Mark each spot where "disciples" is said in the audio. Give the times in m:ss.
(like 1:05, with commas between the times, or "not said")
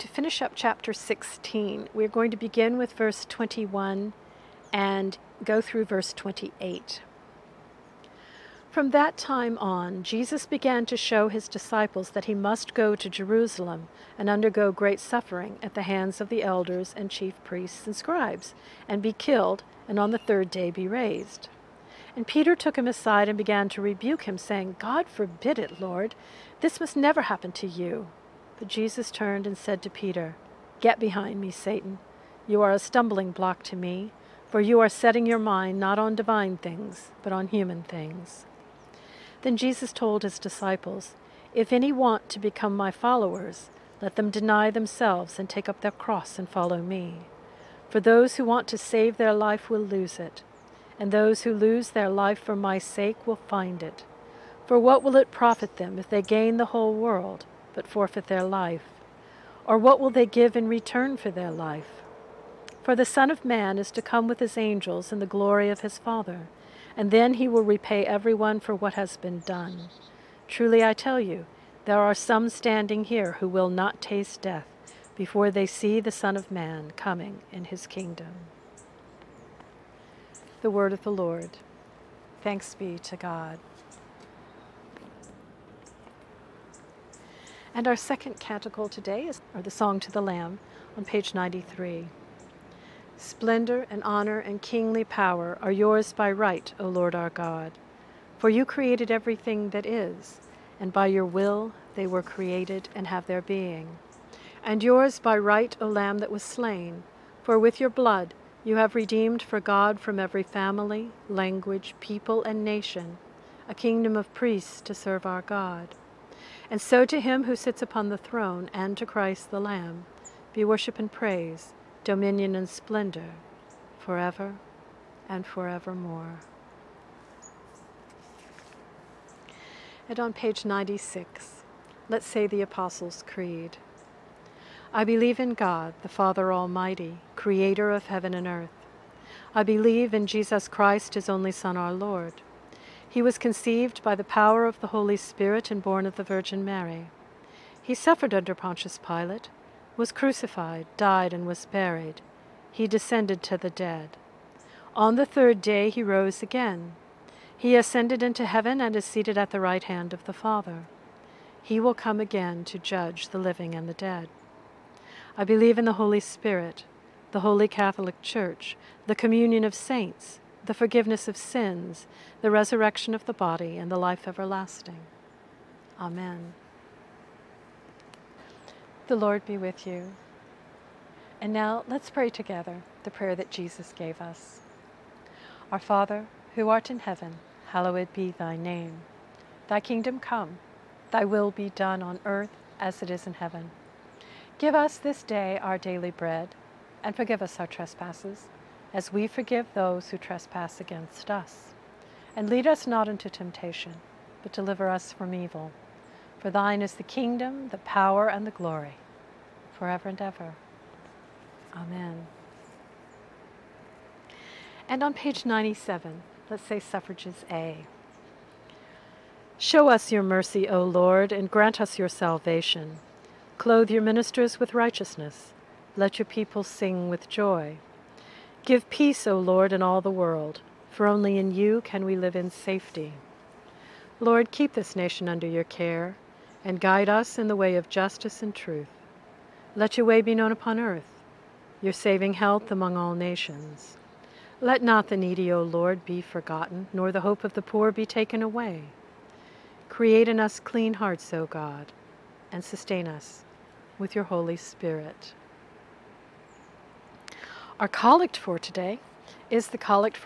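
0:11, 0:40.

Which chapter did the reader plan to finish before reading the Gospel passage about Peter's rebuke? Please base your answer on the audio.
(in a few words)
16.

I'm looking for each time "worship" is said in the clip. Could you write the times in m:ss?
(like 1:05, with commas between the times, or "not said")
2:00.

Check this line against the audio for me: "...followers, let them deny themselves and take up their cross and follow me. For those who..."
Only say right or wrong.
right.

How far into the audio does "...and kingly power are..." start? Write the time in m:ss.
1:34.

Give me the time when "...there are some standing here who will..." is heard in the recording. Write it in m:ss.
1:11.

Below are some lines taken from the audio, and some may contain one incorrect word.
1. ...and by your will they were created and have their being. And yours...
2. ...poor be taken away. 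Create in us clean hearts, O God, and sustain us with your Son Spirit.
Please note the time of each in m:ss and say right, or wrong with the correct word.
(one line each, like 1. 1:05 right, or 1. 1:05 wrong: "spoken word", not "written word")
1. 1:40 right
2. 4:07 wrong: "Holy", not "Son".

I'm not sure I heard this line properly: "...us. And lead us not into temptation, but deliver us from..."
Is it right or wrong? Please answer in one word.
right.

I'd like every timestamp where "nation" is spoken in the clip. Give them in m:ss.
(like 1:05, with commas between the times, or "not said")
1:52, 3:54, 4:03.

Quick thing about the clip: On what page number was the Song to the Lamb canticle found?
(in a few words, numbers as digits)
93.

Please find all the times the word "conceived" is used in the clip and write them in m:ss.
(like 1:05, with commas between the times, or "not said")
2:23.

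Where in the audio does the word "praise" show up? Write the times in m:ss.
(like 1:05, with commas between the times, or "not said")
2:01.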